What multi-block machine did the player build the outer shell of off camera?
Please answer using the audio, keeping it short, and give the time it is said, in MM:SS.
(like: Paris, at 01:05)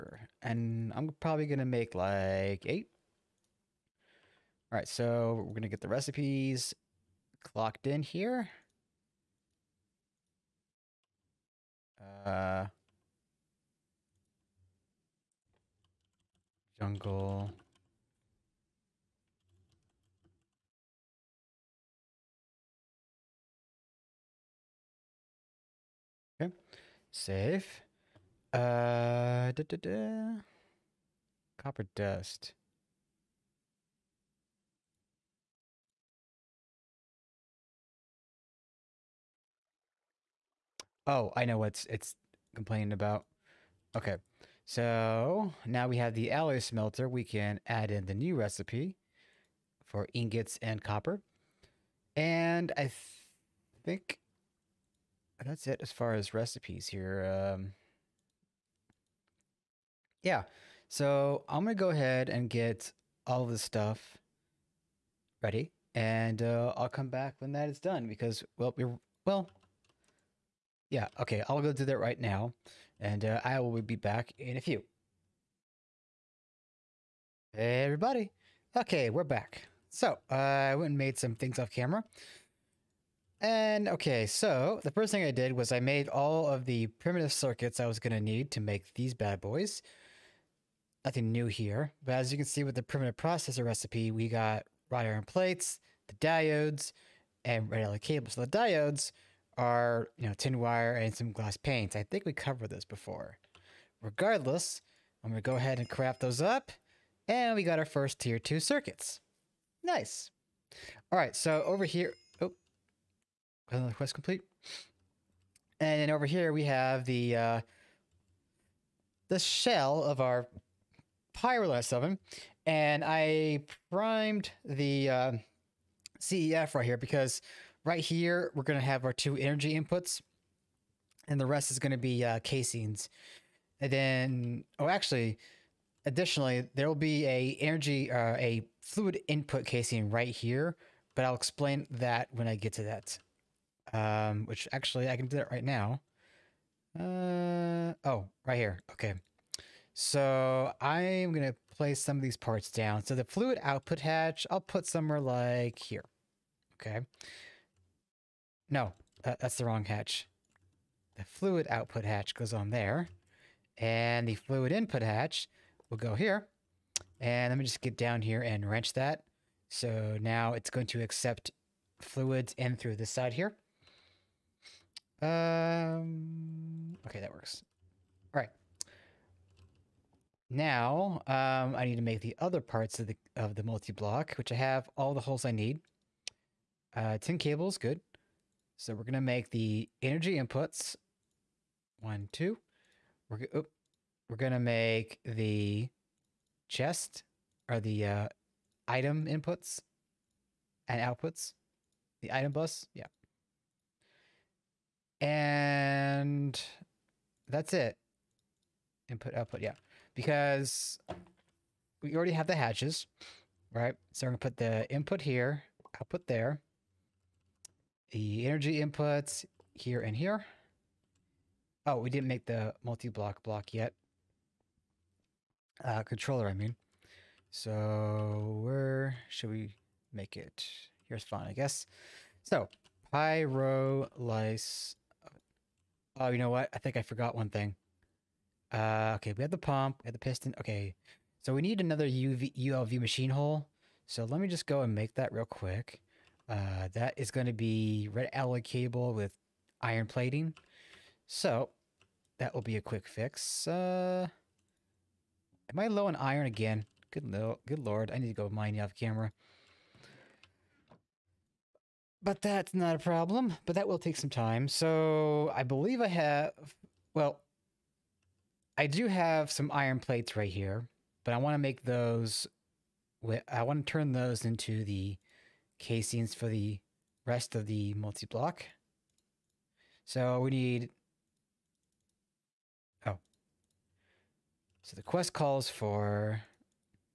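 Pyrolyse oven, at 02:01.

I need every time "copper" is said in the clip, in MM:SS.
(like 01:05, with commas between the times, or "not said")
00:31, 00:50.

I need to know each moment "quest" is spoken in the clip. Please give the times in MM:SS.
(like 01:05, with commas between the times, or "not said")
01:53, 04:45.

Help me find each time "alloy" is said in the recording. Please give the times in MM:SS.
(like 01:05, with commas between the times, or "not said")
00:46, 01:37, 04:08.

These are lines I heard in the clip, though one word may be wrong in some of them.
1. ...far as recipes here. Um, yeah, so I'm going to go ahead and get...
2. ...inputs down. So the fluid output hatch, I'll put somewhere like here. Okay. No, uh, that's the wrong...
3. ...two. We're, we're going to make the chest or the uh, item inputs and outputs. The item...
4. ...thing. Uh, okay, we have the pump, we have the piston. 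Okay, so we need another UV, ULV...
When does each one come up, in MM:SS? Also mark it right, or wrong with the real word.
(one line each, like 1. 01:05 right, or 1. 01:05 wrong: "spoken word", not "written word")
1. 00:55 right
2. 02:32 wrong: "parts", not "inputs"
3. 03:12 right
4. 03:57 right.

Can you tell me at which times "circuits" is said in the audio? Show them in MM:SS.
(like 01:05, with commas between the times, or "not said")
01:27, 01:48.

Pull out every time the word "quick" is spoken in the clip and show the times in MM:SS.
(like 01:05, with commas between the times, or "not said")
04:05, 04:12.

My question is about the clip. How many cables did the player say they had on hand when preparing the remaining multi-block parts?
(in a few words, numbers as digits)
10.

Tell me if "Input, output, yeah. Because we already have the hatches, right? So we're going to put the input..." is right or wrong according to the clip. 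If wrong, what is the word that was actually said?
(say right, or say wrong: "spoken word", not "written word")
right.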